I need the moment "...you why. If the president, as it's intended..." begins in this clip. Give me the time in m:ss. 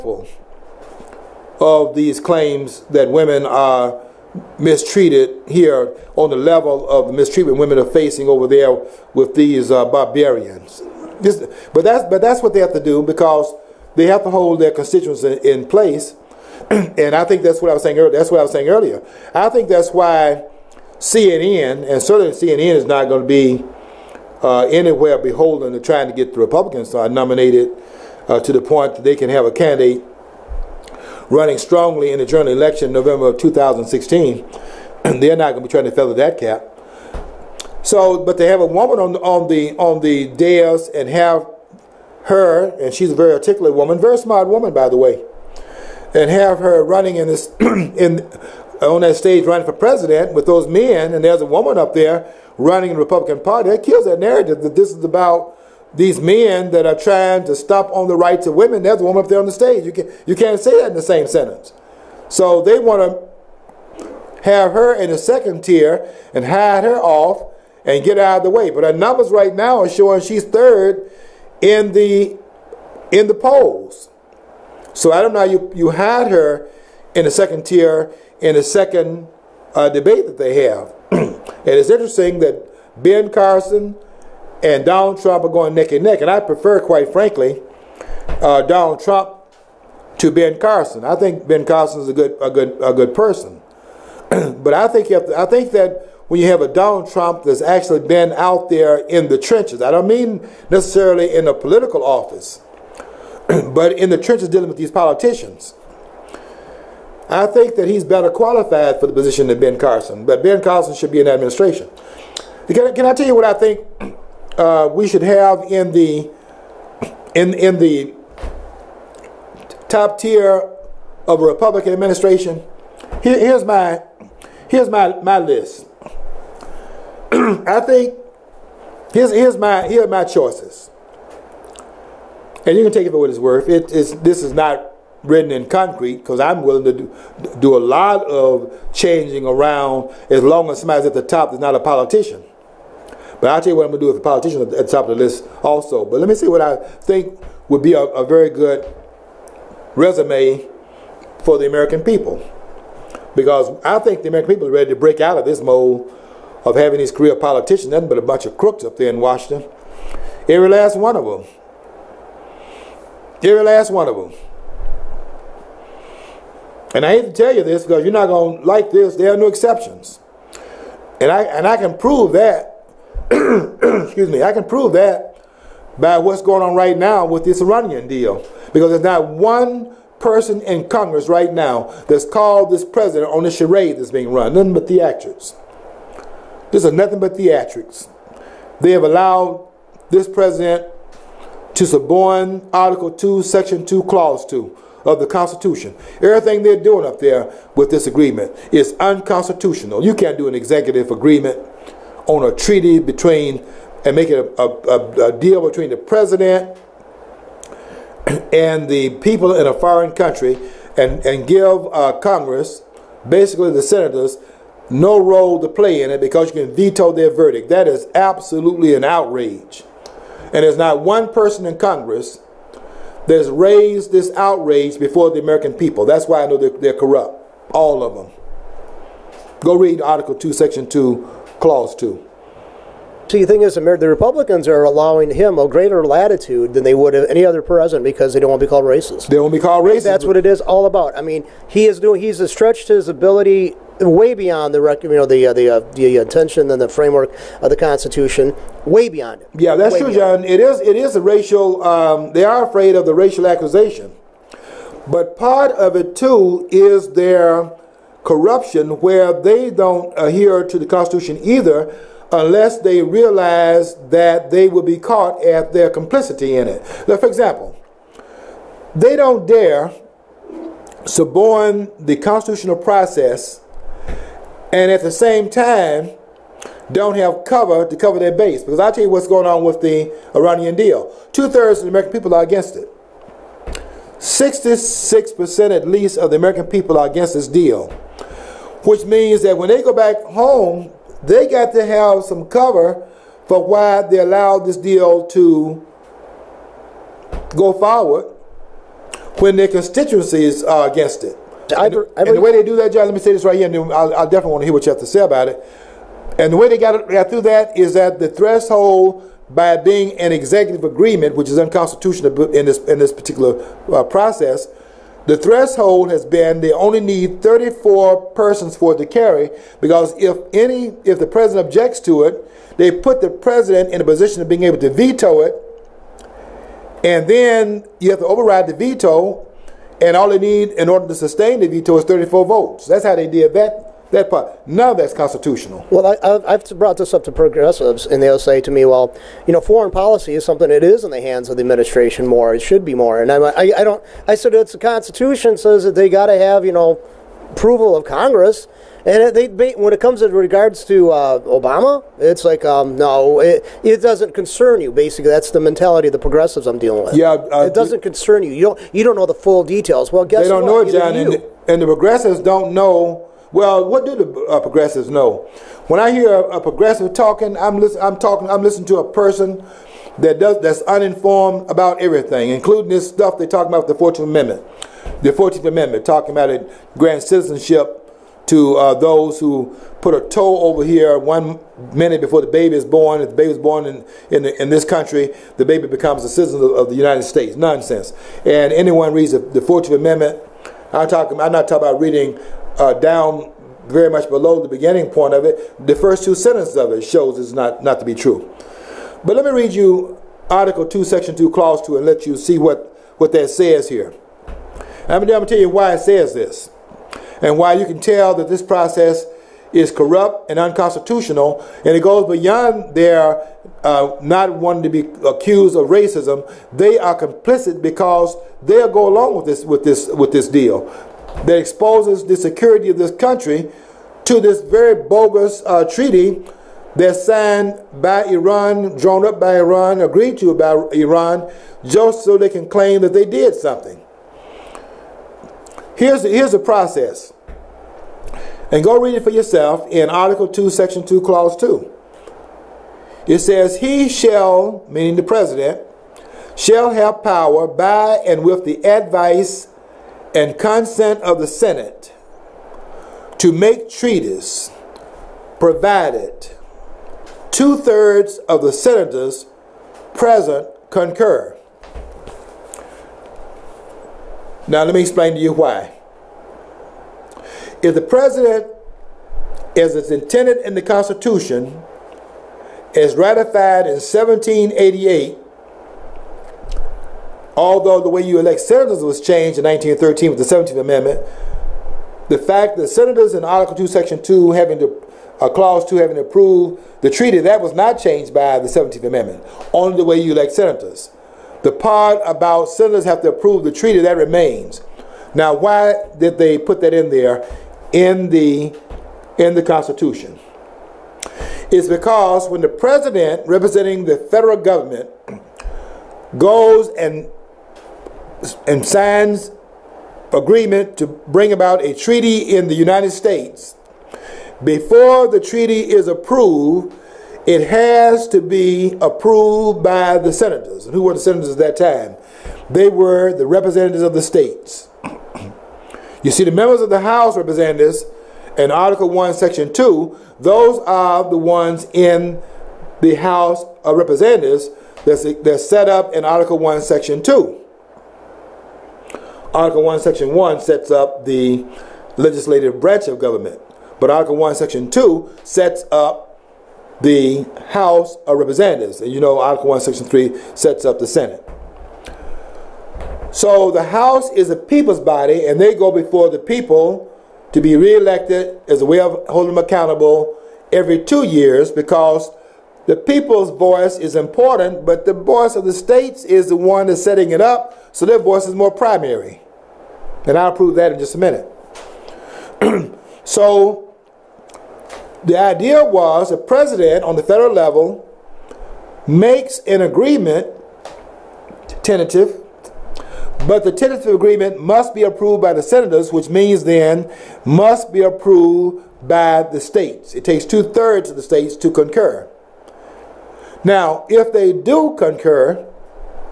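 7:45.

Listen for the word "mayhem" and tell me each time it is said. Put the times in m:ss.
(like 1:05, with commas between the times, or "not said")
not said.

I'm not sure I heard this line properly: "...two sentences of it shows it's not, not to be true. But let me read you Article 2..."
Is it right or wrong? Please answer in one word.
right.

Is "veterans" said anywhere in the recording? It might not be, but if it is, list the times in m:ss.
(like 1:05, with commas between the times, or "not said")
not said.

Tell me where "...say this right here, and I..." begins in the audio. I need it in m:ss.
5:03.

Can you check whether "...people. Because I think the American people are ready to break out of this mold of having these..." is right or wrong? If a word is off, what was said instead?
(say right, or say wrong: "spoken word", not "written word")
right.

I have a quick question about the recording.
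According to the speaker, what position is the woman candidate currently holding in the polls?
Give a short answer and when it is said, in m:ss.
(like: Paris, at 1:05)
third, at 1:10.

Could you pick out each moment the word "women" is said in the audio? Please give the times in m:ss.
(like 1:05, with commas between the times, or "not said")
0:03, 0:07, 0:58.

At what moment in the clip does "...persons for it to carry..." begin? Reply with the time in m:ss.
5:18.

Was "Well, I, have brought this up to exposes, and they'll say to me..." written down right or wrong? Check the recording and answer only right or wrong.
wrong.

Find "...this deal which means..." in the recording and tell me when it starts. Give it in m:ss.
4:47.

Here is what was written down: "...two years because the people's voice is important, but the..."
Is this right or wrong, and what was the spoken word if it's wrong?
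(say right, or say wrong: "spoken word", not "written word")
right.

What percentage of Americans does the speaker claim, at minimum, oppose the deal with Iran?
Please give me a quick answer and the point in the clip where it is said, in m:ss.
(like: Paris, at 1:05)
66%, at 4:44.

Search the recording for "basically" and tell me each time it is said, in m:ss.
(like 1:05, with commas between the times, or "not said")
3:33, 5:54.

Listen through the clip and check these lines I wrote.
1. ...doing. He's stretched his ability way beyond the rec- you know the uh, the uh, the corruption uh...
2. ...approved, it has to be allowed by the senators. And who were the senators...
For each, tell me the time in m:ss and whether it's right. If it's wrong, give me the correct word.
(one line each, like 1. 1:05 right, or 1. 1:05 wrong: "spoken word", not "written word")
1. 4:01 wrong: "intention", not "corruption"
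2. 8:36 wrong: "approved", not "allowed".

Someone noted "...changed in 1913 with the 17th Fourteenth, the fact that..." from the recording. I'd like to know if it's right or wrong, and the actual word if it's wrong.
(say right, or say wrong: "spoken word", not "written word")
wrong: "Amendment", not "Fourteenth".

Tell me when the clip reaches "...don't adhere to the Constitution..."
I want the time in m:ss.
4:19.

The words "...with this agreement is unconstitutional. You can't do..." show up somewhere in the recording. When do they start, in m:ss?
3:17.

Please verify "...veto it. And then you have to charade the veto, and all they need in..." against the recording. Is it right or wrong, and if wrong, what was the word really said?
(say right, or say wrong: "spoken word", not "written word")
wrong: "override", not "charade".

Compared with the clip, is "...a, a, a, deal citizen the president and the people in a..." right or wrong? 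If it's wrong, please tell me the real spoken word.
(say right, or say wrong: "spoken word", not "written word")
wrong: "between", not "citizen".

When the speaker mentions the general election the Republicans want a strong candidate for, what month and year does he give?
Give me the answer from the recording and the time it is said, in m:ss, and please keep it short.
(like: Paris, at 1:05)
November of 2016, at 0:32.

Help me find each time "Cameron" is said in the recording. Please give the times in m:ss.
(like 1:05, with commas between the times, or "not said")
not said.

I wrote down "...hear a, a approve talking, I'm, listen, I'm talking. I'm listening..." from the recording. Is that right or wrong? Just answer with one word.
wrong.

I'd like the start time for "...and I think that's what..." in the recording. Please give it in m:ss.
0:16.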